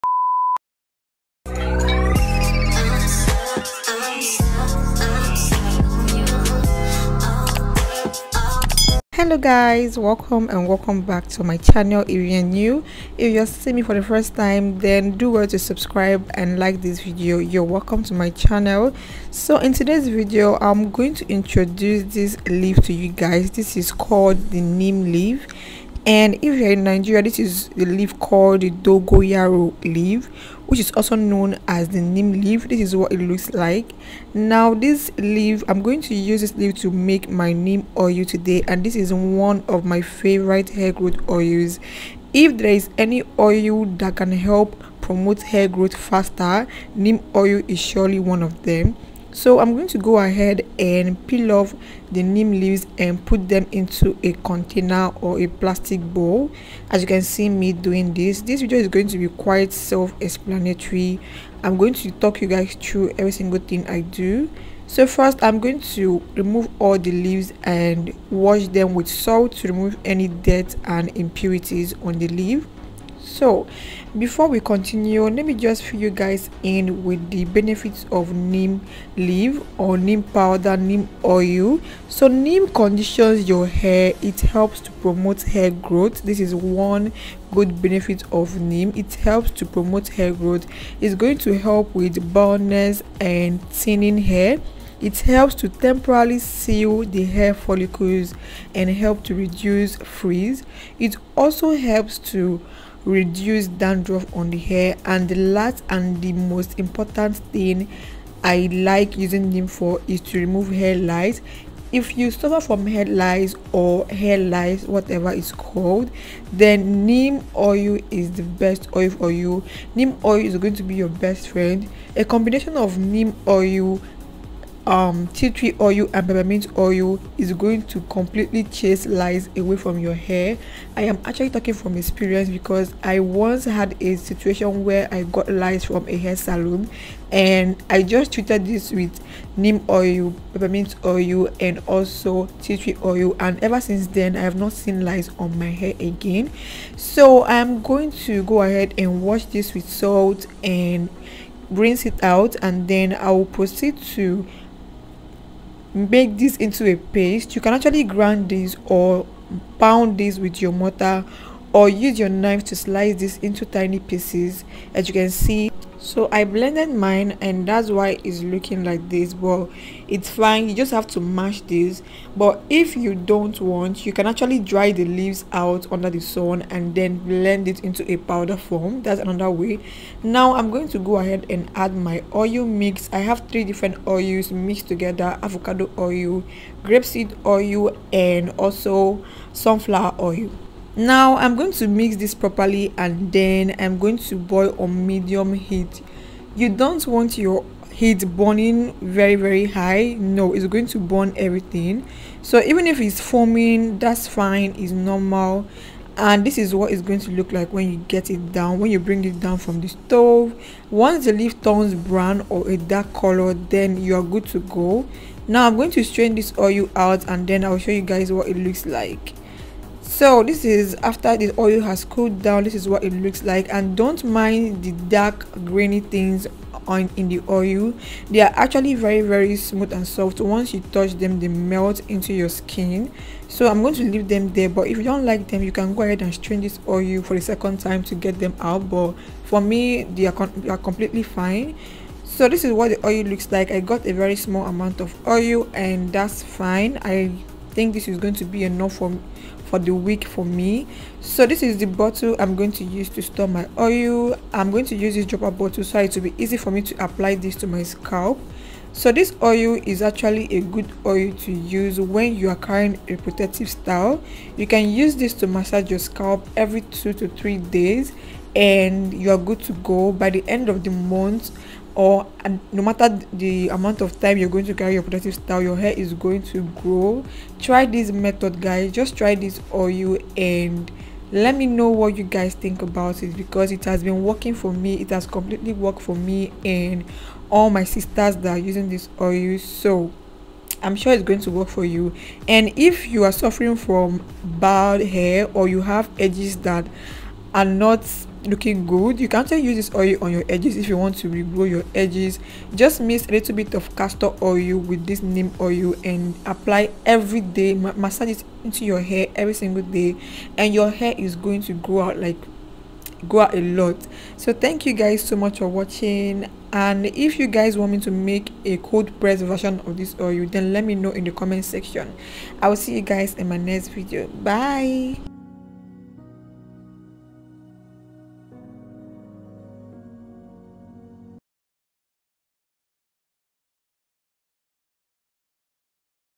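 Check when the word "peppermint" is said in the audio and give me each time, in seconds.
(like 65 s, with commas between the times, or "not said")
126 s, 140 s.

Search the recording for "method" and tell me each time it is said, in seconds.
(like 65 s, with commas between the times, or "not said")
278 s.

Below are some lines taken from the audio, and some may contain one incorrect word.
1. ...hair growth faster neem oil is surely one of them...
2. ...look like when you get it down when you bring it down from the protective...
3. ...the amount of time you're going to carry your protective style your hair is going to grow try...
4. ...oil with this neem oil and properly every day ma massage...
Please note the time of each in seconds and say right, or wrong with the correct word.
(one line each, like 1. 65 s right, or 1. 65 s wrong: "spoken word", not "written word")
1. 45 s right
2. 207 s wrong: "stove", not "protective"
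3. 273 s right
4. 304 s wrong: "apply", not "properly".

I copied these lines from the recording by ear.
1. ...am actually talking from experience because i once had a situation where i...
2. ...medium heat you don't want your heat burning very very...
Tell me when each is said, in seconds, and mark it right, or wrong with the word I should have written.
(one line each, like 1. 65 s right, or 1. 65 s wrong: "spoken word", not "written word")
1. 131 s right
2. 195 s right.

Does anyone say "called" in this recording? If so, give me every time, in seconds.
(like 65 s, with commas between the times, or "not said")
23 s, 28 s, 115 s.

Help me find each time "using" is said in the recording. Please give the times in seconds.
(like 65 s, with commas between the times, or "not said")
109 s, 288 s.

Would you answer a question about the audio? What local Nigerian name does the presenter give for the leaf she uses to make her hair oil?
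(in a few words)
Dogoyaro.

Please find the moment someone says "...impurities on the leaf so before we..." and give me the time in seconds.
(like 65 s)
71 s.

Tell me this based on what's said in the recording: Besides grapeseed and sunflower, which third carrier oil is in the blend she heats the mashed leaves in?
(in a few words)
Avocado oil.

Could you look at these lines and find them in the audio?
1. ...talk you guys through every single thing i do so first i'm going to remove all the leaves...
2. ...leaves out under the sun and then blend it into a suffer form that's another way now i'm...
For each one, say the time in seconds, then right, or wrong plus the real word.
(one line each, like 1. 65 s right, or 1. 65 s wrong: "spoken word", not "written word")
1. 62 s right
2. 175 s wrong: "powder", not "suffer".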